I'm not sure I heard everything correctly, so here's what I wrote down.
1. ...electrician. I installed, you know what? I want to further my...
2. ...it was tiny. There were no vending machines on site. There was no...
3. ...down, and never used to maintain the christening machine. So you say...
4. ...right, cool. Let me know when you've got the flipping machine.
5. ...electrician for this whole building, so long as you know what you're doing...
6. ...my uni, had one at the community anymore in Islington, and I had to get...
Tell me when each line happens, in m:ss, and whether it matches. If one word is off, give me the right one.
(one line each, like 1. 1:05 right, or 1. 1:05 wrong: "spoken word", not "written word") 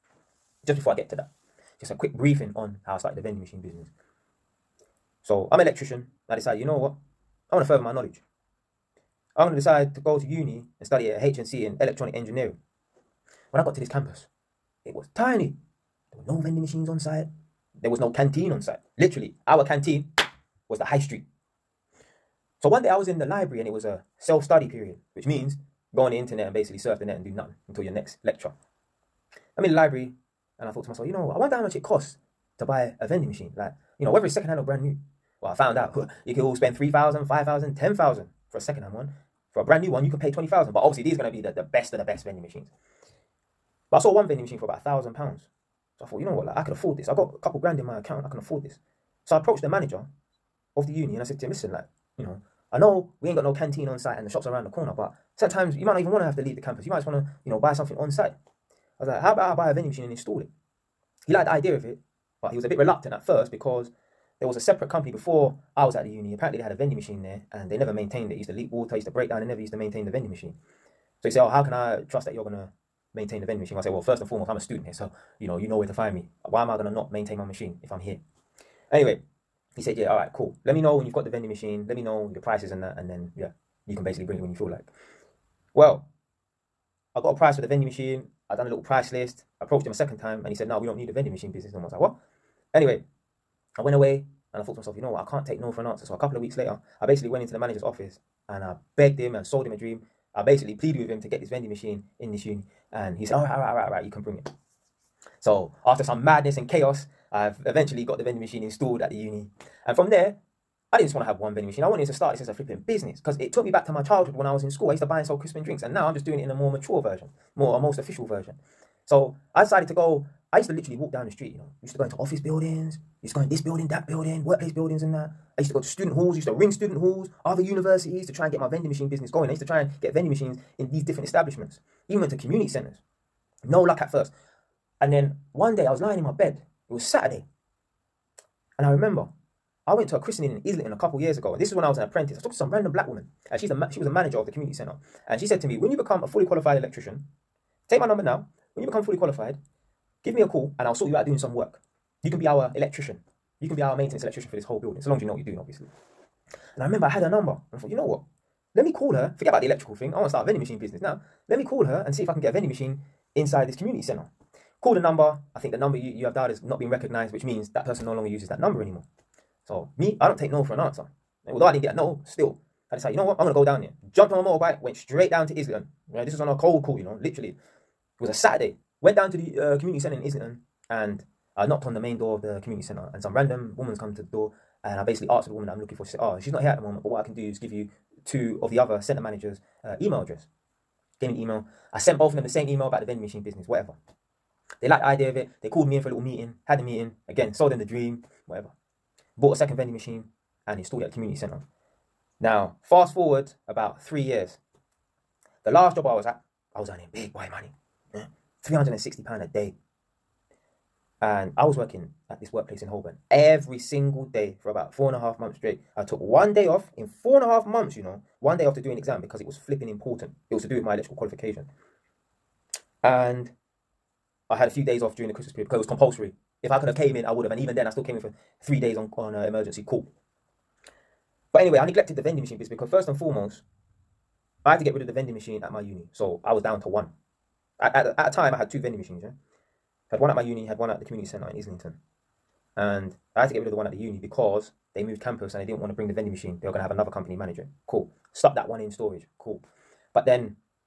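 1. 0:05 wrong: "decided", not "installed"
2. 0:14 right
3. 1:09 wrong: "vending", not "christening"
4. 1:20 wrong: "vending", not "flipping"
5. 2:34 right
6. 4:00 wrong: "centre", not "anymore".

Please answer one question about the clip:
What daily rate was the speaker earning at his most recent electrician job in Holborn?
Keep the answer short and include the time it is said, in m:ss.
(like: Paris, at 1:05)
£360 a day, at 3:28.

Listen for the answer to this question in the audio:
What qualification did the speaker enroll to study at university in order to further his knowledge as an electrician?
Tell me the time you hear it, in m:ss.
0:11.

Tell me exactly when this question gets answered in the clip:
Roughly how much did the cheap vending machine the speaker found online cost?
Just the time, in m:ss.
0:44.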